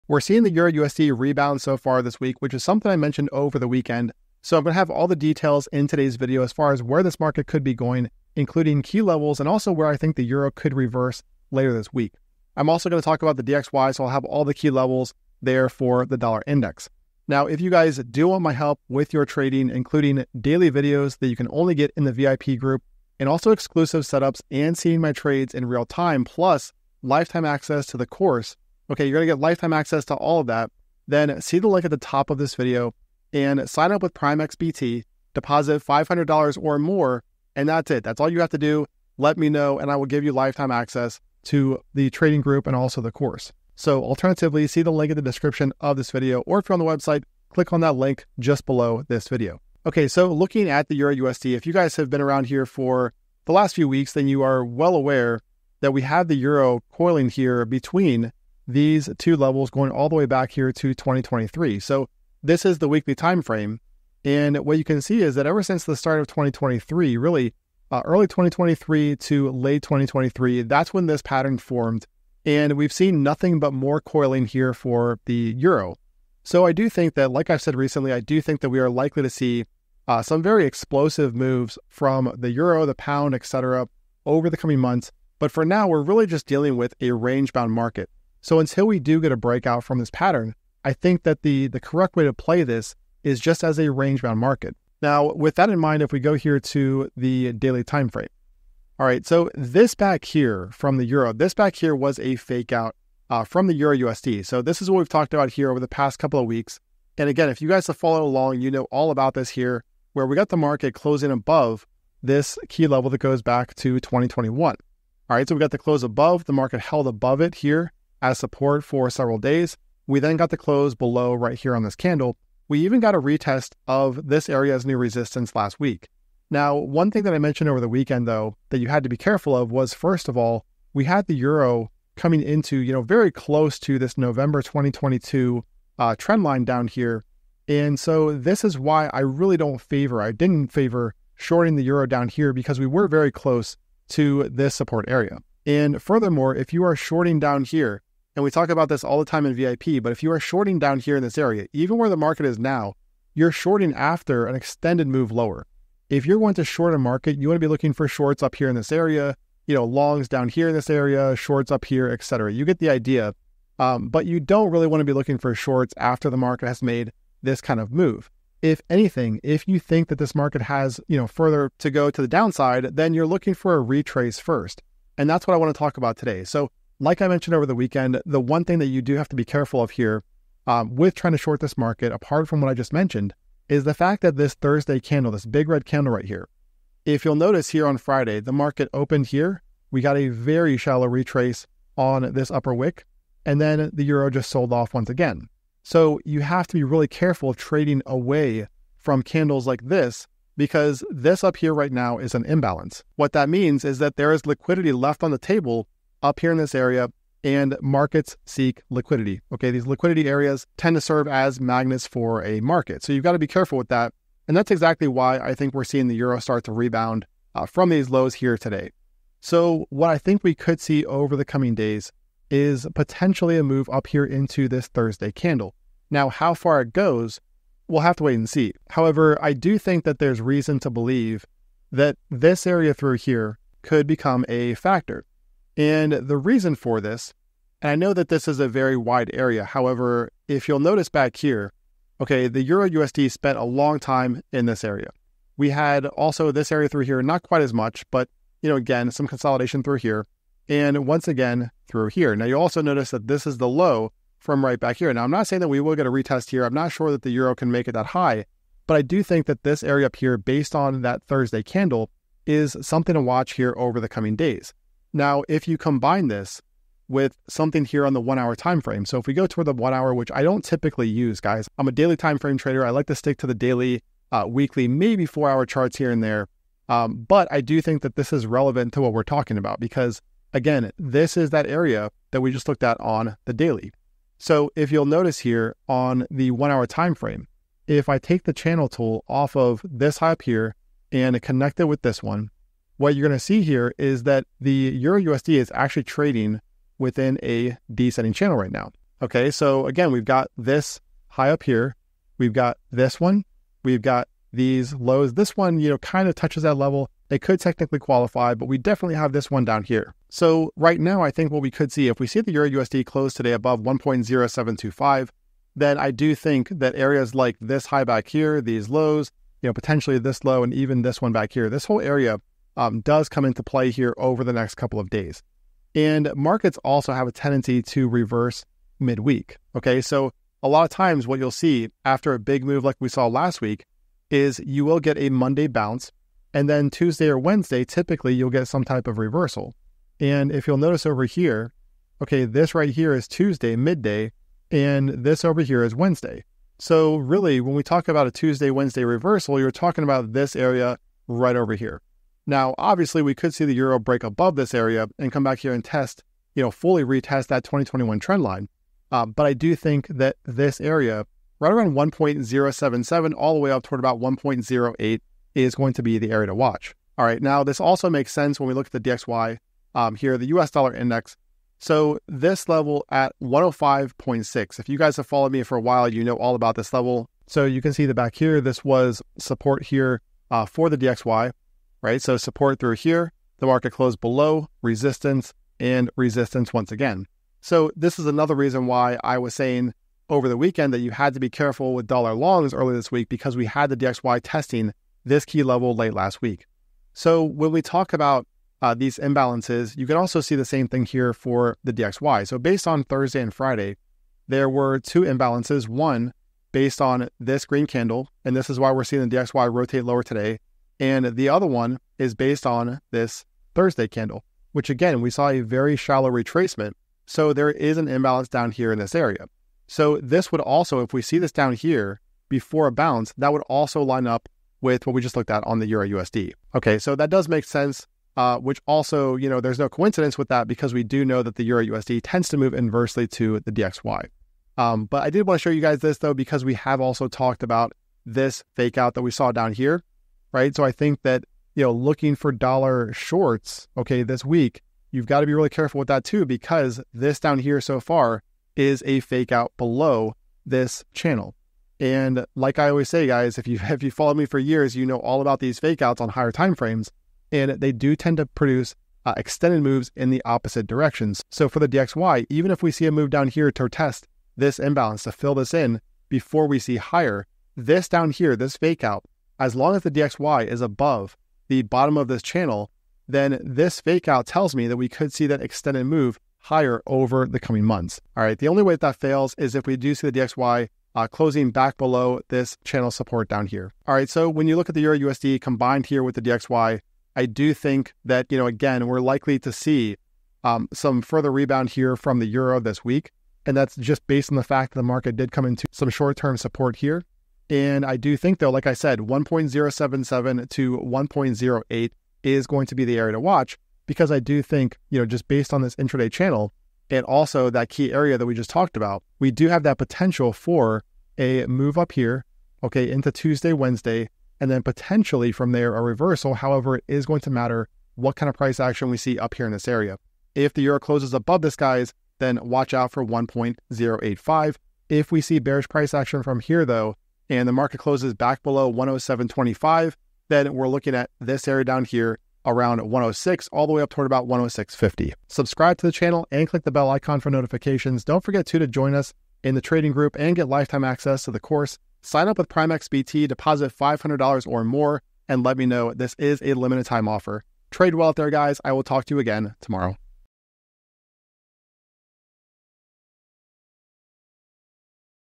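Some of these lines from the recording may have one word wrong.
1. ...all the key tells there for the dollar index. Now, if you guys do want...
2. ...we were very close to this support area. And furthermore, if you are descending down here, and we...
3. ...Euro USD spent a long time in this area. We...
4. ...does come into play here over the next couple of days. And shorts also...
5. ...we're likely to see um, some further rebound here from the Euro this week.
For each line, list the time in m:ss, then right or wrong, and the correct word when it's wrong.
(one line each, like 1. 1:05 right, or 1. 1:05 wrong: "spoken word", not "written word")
1. 0:14 wrong: "levels", not "tells"
2. 2:22 wrong: "shorting", not "descending"
3. 4:02 right
4. 5:23 wrong: "markets", not "shorts"
5. 8:09 right.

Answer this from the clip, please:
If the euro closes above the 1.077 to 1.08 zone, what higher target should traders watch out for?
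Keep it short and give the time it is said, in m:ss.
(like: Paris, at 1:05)
1.085, at 8:43.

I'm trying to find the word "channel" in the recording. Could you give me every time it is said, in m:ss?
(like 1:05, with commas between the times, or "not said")
4:48, 4:58, 7:31, 7:52, 8:02, 8:26, 8:56.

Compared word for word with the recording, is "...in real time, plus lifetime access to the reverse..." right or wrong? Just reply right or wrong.
wrong.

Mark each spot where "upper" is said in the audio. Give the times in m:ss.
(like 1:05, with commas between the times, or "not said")
3:12.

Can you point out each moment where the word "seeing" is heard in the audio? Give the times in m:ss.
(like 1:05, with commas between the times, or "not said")
0:00, 0:24, 3:35, 6:49.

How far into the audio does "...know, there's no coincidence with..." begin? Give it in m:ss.
7:09.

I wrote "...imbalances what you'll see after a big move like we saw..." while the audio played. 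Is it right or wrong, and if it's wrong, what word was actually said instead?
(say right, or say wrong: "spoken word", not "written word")
wrong: "times", not "imbalances".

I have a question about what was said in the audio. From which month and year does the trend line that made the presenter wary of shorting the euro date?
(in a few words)
November 2022.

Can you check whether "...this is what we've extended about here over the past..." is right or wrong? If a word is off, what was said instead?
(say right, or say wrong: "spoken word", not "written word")
wrong: "talked", not "extended".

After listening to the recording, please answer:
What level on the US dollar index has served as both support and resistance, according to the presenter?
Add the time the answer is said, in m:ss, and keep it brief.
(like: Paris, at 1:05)
105.6, at 6:13.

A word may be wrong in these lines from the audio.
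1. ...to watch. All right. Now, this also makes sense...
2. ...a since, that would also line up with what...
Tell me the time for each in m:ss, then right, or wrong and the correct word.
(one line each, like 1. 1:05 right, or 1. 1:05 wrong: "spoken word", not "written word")
1. 6:06 right
2. 7:02 wrong: "bounce", not "since".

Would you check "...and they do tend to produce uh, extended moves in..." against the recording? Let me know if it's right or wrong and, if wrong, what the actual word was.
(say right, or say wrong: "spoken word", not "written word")
right.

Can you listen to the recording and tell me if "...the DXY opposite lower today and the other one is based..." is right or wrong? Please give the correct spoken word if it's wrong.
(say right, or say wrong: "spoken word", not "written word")
wrong: "rotate", not "opposite".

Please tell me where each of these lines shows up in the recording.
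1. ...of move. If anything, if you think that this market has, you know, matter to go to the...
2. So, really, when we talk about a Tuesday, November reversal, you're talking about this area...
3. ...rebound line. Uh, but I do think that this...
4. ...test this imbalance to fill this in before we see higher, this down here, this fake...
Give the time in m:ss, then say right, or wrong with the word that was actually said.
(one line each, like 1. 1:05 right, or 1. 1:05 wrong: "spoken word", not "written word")
1. 2:47 wrong: "further", not "matter"
2. 5:46 wrong: "Wednesday", not "November"
3. 5:58 wrong: "trend", not "rebound"
4. 7:43 right.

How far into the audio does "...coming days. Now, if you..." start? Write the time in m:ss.
4:24.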